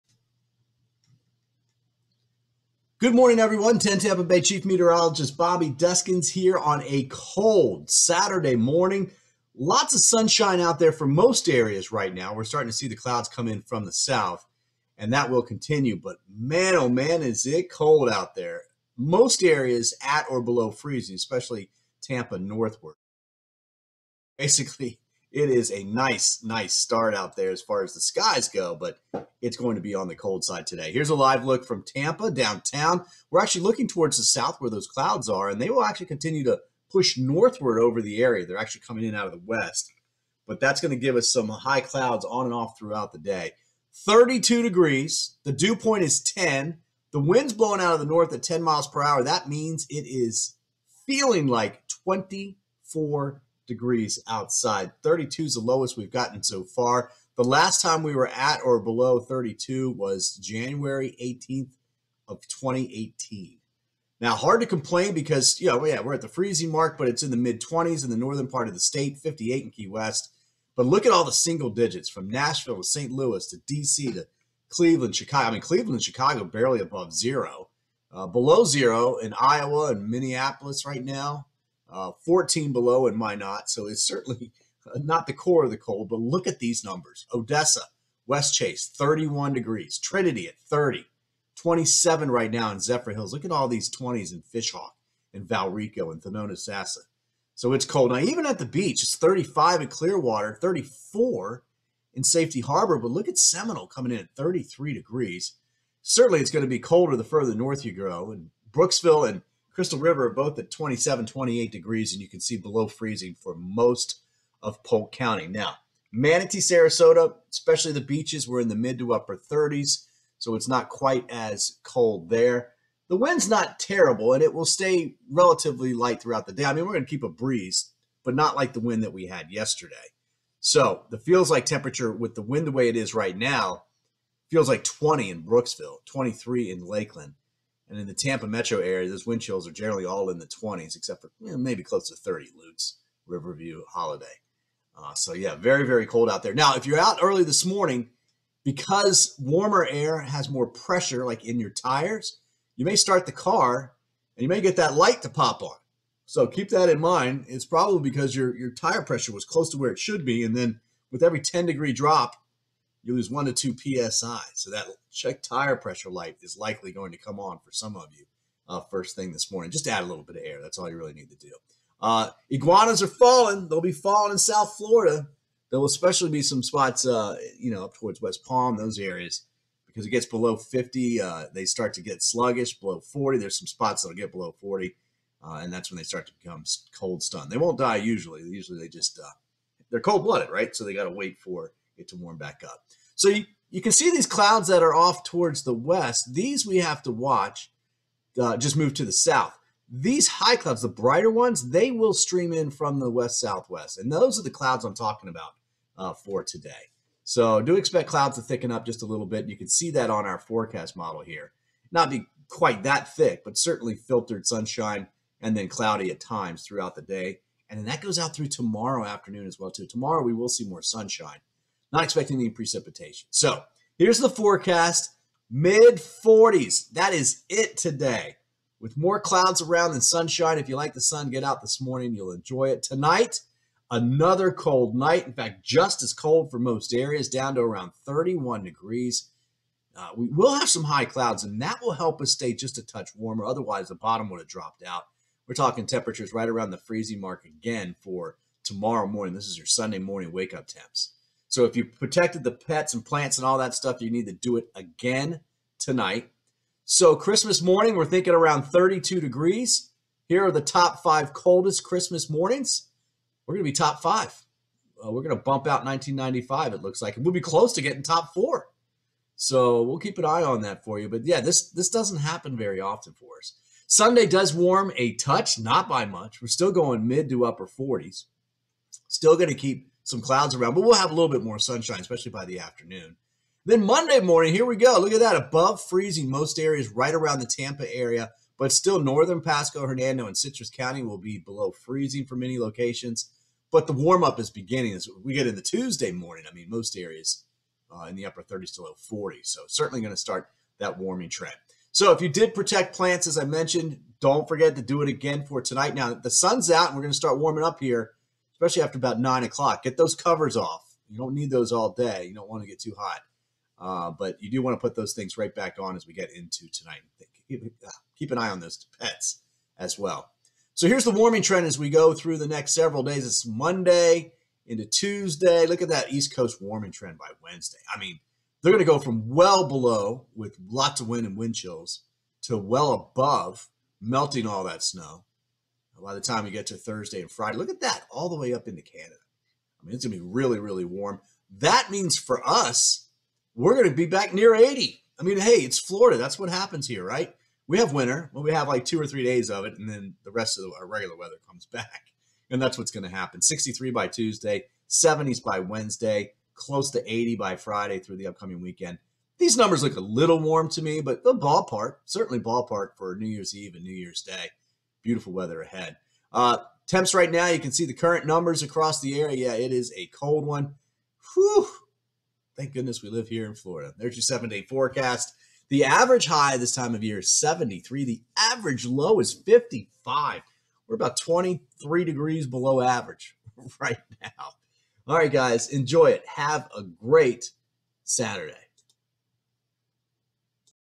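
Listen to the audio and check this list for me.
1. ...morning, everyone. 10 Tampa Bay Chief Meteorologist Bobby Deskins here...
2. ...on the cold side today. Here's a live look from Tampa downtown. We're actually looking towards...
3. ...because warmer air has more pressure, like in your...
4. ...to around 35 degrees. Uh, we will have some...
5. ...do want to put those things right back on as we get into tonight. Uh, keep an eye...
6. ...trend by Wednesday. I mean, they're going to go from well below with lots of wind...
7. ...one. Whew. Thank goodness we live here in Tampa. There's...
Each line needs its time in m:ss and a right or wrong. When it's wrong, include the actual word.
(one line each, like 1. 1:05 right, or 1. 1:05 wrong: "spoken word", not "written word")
1. 0:03 right
2. 0:29 right
3. 2:28 right
4. 3:57 wrong: "31", not "35"
5. 5:14 right
6. 5:26 right
7. 6:10 wrong: "Florida", not "Tampa".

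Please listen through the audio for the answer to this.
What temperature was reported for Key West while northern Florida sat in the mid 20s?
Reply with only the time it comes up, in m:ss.
1:09.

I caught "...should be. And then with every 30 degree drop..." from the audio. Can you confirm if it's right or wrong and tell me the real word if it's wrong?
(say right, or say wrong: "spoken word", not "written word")
wrong: "10", not "30".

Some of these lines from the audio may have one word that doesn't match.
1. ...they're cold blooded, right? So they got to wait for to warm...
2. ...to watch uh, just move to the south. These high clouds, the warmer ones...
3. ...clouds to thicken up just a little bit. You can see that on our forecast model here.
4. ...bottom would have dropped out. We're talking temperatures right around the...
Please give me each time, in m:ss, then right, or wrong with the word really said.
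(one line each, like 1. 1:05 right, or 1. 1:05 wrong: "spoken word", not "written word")
1. 3:09 right
2. 3:17 wrong: "brighter", not "warmer"
3. 3:28 right
4. 4:03 right.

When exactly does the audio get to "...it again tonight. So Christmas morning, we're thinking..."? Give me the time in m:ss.
4:14.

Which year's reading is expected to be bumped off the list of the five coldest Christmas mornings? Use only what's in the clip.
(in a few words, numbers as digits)
1995.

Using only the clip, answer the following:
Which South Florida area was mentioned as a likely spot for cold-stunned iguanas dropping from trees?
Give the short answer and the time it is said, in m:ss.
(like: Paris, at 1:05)
West Palm, at 2:58.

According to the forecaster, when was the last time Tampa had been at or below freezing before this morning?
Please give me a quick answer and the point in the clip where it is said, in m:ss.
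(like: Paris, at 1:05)
January 18th of 2018, at 1:00.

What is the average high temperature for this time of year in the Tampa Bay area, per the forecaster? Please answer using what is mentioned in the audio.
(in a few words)
73.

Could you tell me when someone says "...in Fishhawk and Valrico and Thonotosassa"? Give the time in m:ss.
1:34.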